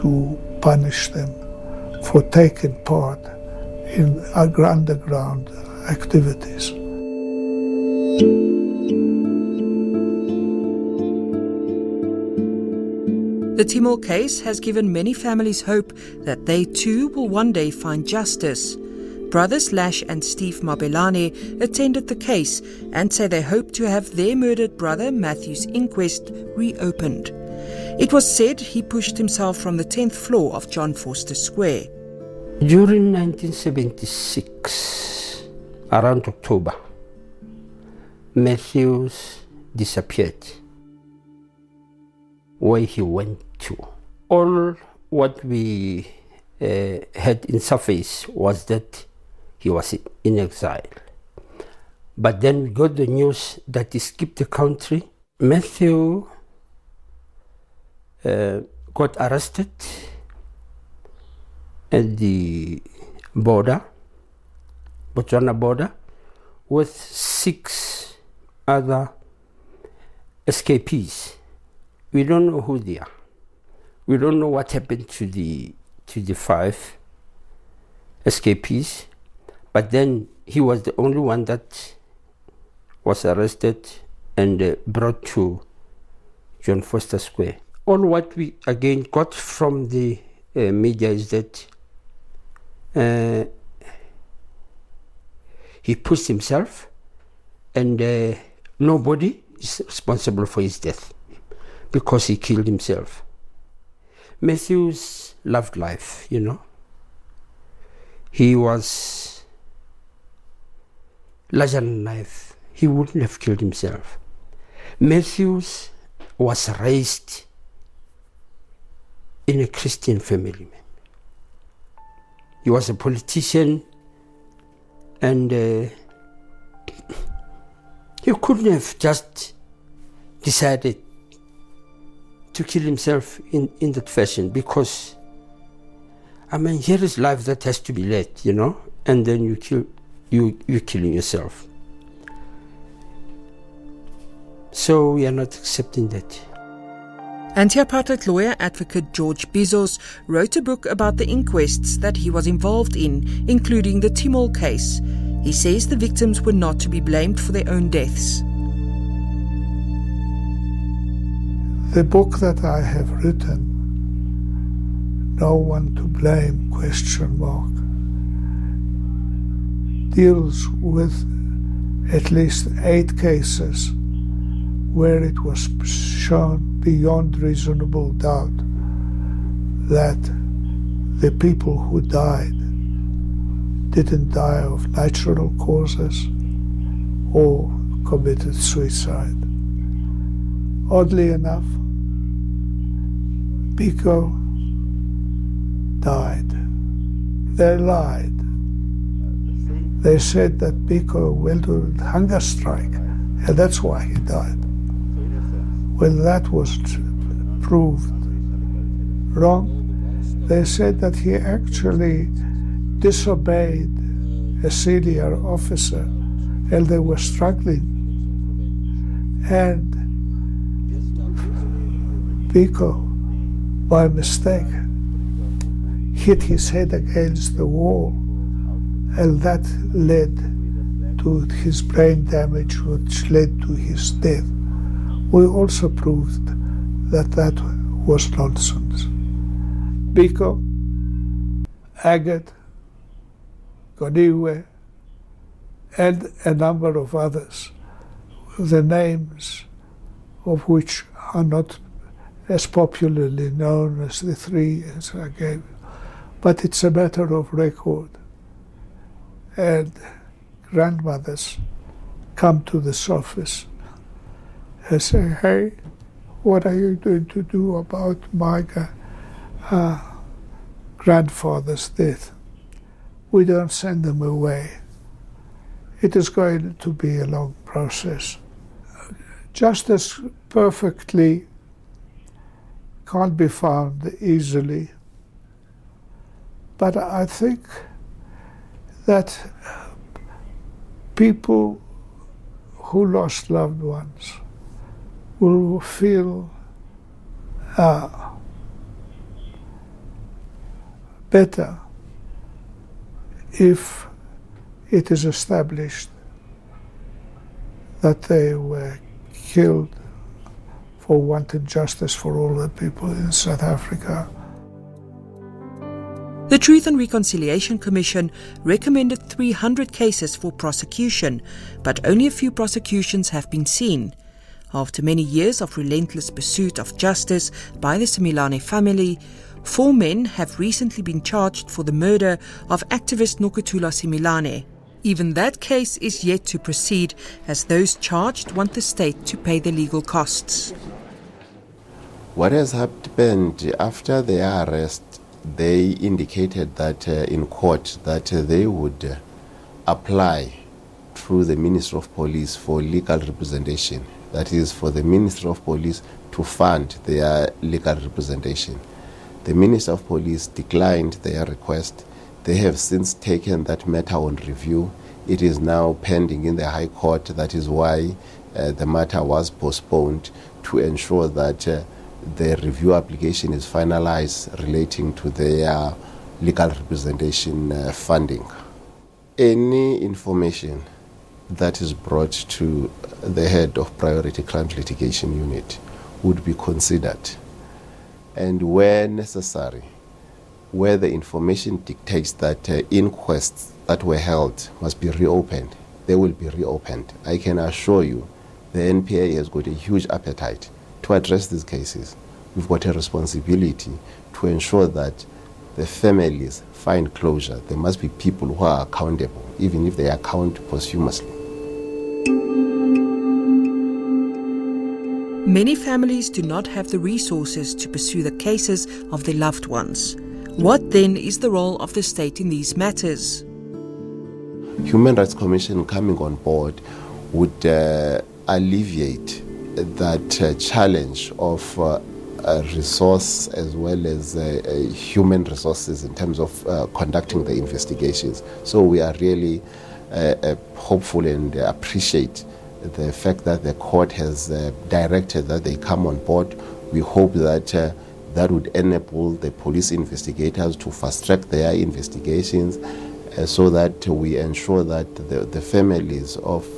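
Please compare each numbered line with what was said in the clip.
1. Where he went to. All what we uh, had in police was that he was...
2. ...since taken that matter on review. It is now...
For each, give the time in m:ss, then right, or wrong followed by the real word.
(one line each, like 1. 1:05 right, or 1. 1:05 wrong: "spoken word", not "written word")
1. 0:42 wrong: "surface", not "police"
2. 6:02 right.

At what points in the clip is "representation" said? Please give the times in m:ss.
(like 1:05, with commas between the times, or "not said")
5:53, 5:57, 6:16.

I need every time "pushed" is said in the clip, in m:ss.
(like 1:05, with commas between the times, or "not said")
0:28, 1:35.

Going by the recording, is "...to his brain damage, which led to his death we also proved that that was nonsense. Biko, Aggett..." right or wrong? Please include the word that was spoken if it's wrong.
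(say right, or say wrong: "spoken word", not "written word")
right.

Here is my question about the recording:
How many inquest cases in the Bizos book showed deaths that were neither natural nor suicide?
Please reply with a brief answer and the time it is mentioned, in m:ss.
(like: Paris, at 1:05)
8, at 2:52.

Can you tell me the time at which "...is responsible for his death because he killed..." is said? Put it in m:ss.
1:39.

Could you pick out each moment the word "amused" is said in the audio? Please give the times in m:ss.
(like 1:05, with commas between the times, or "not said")
not said.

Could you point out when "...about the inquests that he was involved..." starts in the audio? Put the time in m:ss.
2:30.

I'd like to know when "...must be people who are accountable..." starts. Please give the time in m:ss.
6:47.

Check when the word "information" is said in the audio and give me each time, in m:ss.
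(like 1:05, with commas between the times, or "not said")
6:20, 6:31.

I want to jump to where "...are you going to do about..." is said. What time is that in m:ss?
4:26.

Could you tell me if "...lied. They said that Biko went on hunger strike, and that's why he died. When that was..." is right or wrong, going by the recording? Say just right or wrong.
right.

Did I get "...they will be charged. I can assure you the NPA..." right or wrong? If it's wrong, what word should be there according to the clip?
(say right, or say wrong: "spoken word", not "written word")
wrong: "reopened", not "charged".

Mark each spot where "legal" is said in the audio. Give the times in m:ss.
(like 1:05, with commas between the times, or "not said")
5:39, 5:52, 5:57, 6:16.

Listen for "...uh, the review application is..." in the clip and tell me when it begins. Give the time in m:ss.
6:11.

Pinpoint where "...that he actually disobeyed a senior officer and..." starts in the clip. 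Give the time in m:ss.
3:30.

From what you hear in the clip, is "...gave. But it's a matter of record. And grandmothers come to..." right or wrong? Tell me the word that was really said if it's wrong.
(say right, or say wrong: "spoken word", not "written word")
right.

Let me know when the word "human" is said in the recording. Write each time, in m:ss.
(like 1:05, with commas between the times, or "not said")
7:04, 7:14.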